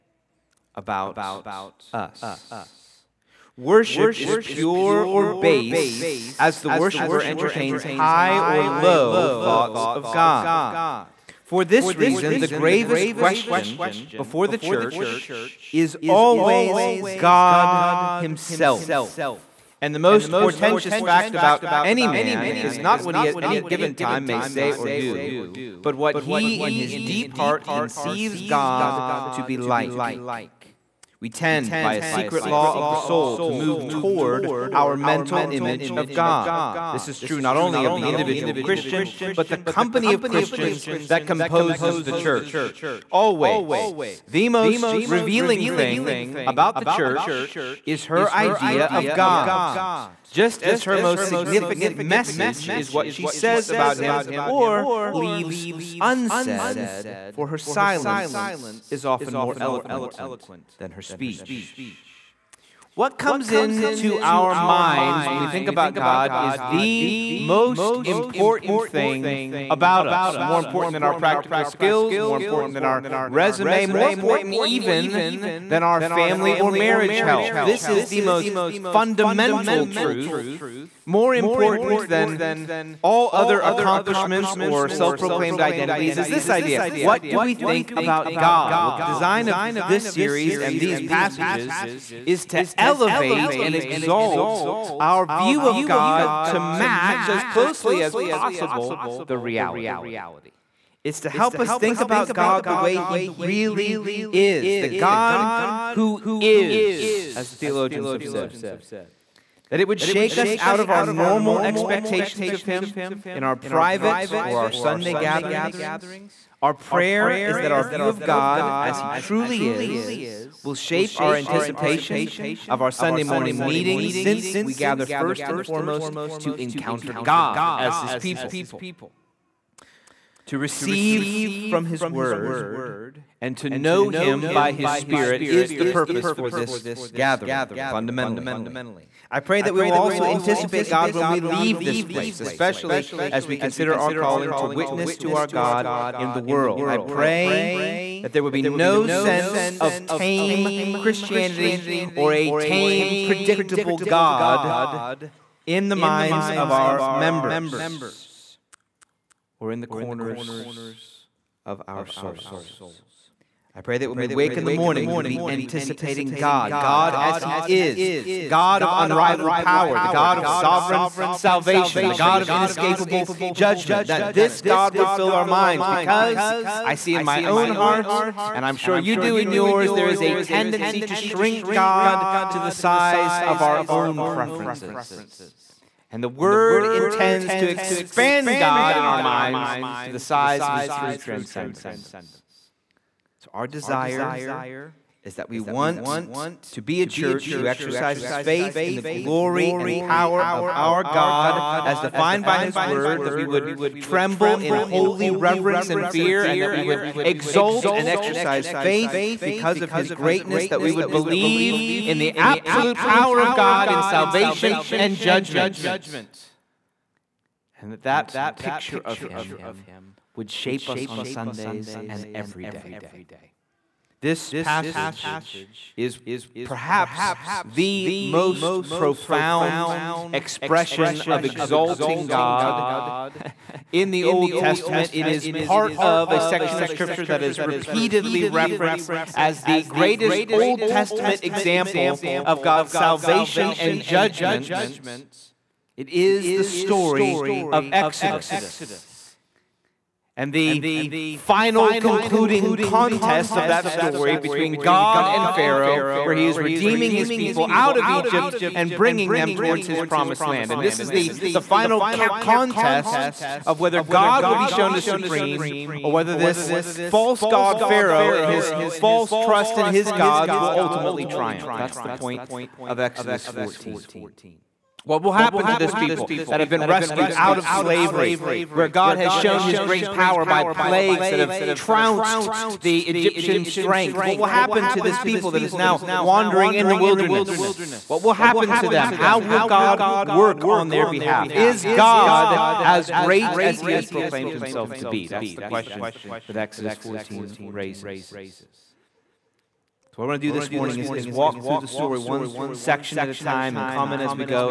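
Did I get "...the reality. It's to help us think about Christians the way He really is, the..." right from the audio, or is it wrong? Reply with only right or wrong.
wrong.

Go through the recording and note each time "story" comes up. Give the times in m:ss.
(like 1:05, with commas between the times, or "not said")
4:06, 4:13, 5:01.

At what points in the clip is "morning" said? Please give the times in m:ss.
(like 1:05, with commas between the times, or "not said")
2:03, 2:44, 5:00.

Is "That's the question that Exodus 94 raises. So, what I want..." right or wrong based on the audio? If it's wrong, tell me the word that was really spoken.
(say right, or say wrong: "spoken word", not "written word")
wrong: "14", not "94".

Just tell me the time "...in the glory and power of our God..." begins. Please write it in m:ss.
3:18.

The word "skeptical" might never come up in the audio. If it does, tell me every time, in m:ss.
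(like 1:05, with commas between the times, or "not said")
not said.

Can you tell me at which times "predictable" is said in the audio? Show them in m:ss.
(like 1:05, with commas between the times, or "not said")
2:33.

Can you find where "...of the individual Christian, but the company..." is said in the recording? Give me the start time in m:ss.
0:37.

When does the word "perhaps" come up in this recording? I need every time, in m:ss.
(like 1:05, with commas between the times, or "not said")
3:46.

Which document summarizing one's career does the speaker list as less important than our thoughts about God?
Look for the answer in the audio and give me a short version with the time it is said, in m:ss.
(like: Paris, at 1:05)
resume, at 1:13.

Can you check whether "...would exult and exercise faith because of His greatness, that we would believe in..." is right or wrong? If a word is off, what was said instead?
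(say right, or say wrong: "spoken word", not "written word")
right.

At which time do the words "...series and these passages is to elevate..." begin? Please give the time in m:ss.
1:30.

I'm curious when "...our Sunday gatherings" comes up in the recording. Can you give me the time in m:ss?
1:54.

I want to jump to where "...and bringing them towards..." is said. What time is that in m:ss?
4:18.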